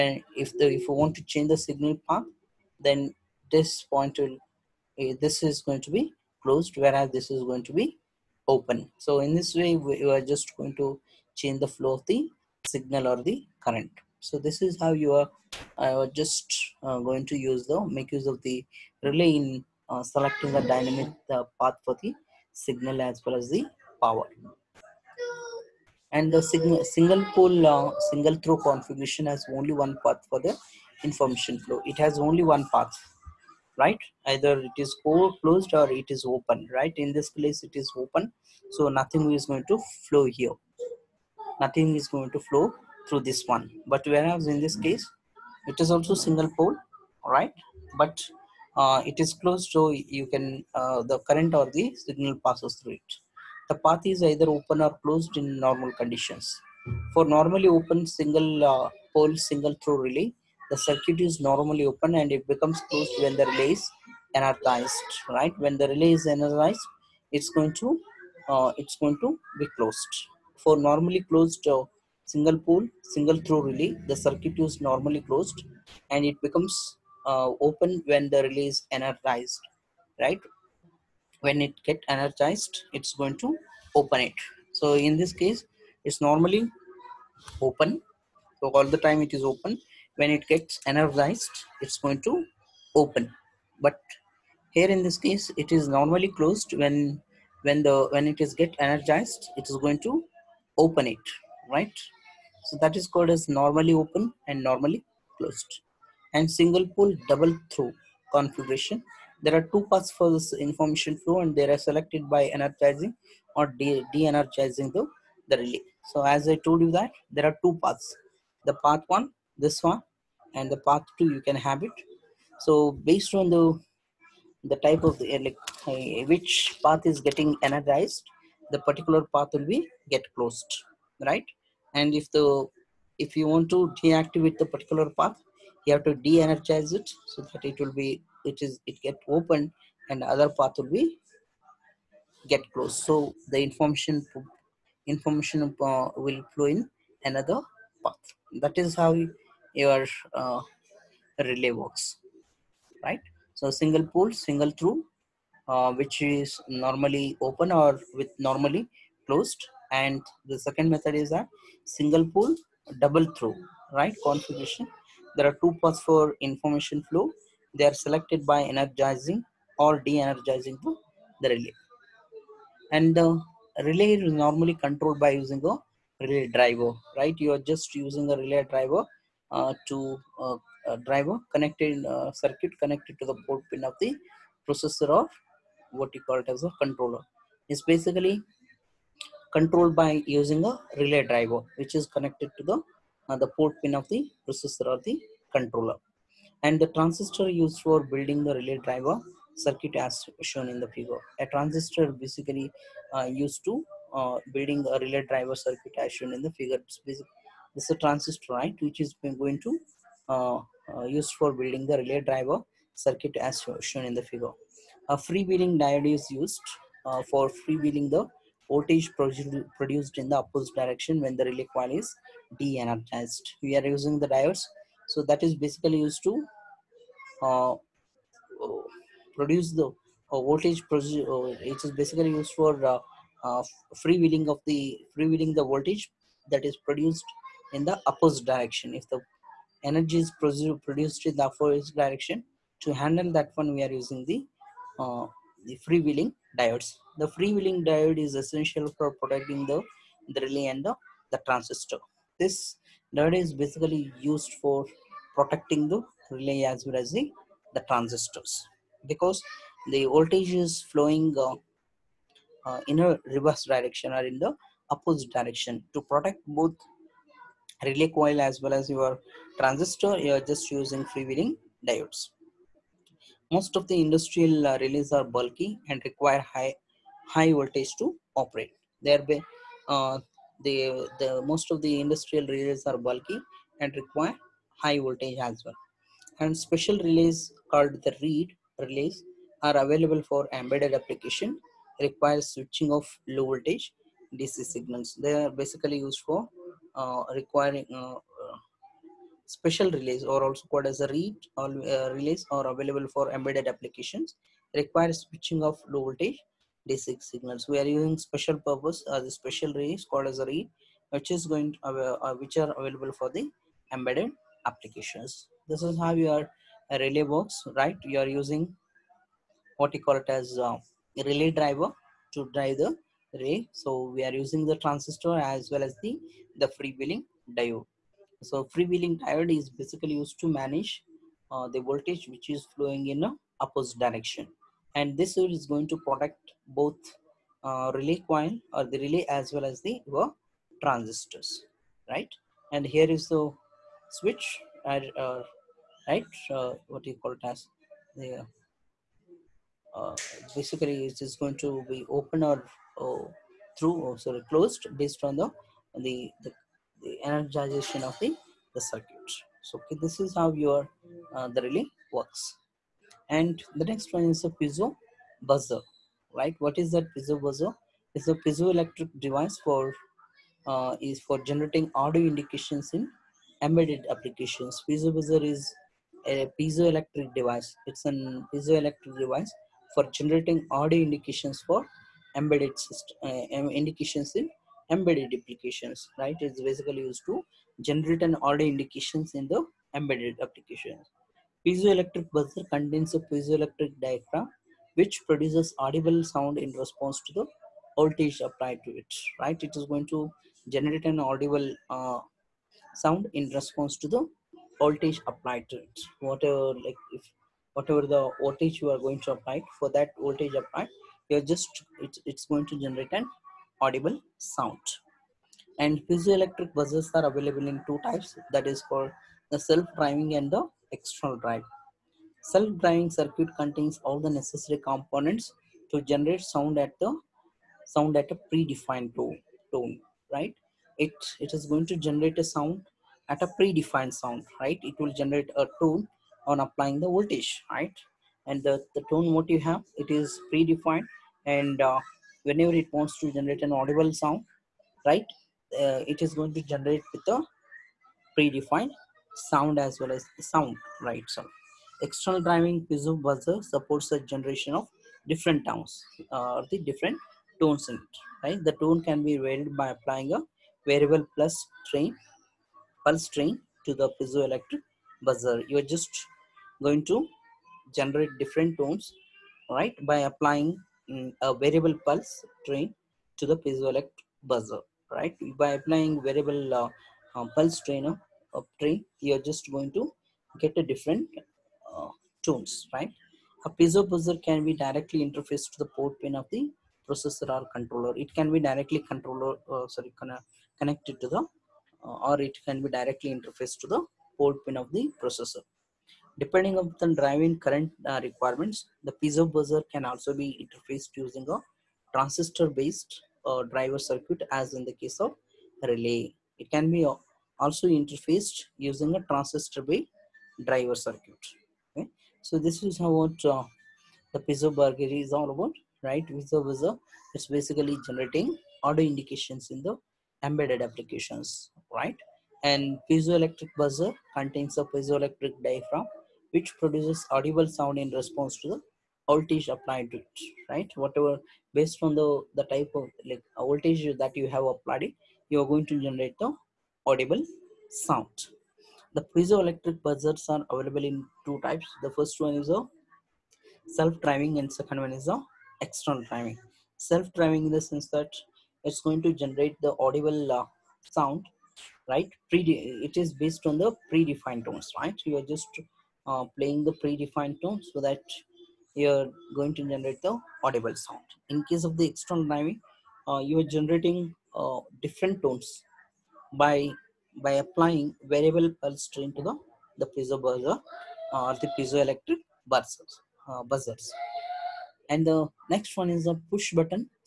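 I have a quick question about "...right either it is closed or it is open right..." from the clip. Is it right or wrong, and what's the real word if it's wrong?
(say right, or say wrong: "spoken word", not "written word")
right.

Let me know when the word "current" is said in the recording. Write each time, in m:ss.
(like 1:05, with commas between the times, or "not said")
0:13, 0:51, 8:17.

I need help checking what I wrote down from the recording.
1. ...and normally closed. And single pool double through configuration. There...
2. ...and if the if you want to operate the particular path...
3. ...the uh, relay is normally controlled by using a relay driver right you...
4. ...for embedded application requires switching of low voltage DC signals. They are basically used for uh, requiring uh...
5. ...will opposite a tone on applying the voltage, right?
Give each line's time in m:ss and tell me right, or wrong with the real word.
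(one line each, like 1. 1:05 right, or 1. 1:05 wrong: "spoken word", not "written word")
1. 1:44 right
2. 2:11 wrong: "deactivate", not "operate"
3. 2:53 right
4. 4:50 right
5. 7:14 wrong: "generate", not "opposite".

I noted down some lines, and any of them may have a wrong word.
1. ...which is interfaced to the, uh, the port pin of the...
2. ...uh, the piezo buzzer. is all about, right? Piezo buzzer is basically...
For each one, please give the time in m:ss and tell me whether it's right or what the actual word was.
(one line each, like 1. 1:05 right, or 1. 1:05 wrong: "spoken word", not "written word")
1. 3:11 wrong: "connected", not "interfaced"
2. 8:33 right.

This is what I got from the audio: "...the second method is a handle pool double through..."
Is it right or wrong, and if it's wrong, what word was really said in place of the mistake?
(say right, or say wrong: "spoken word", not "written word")
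wrong: "single", not "handle".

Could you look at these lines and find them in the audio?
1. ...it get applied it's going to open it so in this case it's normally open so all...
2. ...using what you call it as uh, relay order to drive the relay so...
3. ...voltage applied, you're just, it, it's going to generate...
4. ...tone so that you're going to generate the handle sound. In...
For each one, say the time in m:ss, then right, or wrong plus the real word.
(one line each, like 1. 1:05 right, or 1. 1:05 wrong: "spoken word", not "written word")
1. 1:21 wrong: "energized", not "applied"
2. 5:18 wrong: "driver", not "order"
3. 6:50 right
4. 9:17 wrong: "audible", not "handle".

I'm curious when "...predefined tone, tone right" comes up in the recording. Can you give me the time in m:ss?
7:08.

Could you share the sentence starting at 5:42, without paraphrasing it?
And here is the switch, uh, uh right?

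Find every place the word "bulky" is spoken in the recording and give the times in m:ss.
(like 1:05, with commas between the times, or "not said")
4:35, 4:42.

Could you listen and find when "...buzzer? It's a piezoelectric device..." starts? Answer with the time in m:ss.
6:07.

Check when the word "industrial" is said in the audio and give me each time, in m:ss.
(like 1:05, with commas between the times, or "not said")
4:34, 4:41.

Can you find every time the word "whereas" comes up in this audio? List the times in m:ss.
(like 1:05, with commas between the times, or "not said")
0:06, 0:44.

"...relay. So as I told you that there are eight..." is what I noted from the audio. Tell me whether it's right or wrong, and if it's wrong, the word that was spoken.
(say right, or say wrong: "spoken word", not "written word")
wrong: "two", not "eight".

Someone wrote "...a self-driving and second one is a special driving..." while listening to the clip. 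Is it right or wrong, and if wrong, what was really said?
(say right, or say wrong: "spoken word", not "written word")
wrong: "external", not "special".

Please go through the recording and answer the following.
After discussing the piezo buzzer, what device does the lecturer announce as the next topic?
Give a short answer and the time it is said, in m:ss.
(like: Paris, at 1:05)
push button, at 9:36.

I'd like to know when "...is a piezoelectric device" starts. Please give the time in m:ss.
6:15.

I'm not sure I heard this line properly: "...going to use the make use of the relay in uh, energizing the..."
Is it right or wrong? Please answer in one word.
wrong.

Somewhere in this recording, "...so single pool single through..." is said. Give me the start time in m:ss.
2:33.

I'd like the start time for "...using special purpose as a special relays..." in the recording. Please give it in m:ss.
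5:07.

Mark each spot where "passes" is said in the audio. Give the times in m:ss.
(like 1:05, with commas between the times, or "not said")
0:52.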